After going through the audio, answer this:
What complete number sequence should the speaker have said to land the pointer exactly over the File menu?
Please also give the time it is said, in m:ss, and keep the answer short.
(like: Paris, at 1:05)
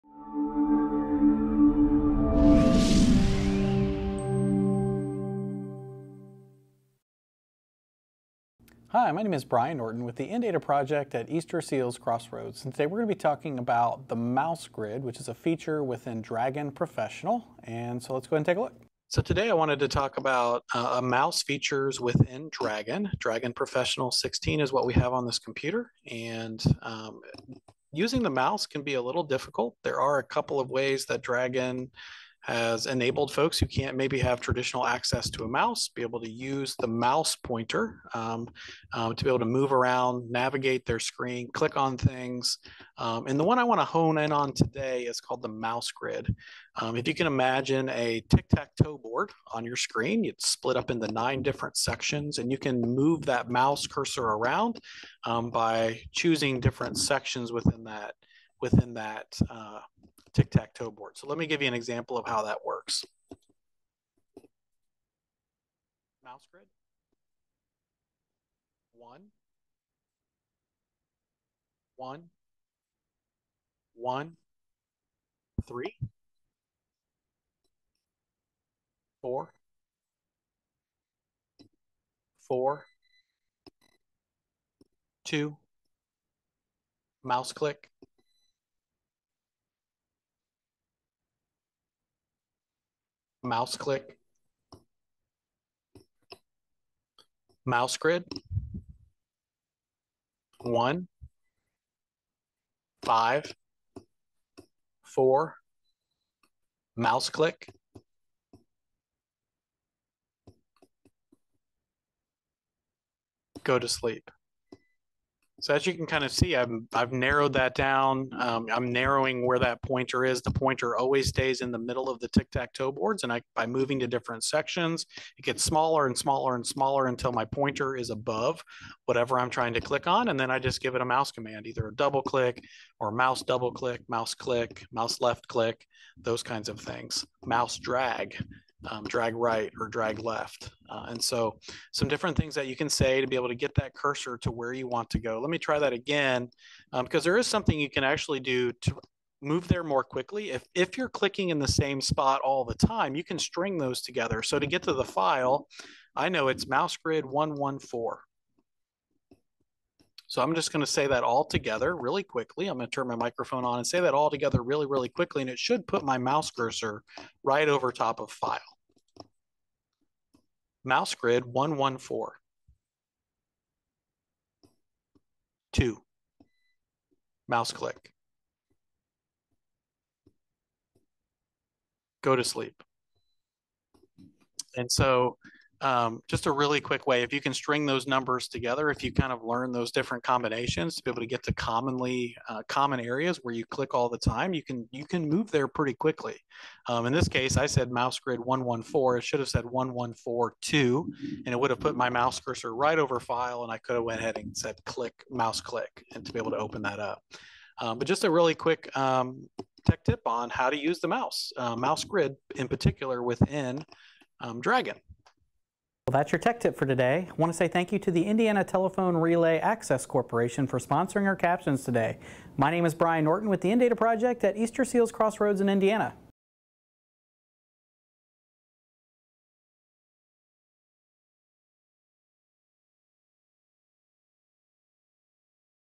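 1142, at 3:19.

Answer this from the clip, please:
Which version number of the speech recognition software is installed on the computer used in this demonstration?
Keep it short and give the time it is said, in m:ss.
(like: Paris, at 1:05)
16, at 0:23.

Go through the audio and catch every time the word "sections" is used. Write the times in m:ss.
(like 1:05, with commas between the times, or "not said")
0:51, 0:56, 2:04.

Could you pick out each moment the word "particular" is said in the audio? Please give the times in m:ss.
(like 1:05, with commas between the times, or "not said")
3:32.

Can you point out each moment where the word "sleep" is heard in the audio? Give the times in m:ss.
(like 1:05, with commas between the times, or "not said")
1:53, 3:02.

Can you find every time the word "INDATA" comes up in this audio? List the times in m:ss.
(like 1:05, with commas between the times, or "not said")
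0:10, 3:43.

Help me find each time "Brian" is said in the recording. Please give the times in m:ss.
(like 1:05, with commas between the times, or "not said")
0:09, 3:42.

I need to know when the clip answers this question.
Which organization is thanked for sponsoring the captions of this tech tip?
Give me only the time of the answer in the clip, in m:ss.
3:38.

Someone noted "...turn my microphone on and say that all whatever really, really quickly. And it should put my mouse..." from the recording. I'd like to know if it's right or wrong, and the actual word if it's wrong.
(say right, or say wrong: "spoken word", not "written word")
wrong: "together", not "whatever".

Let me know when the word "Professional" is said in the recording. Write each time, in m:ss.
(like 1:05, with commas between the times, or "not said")
0:16, 0:23.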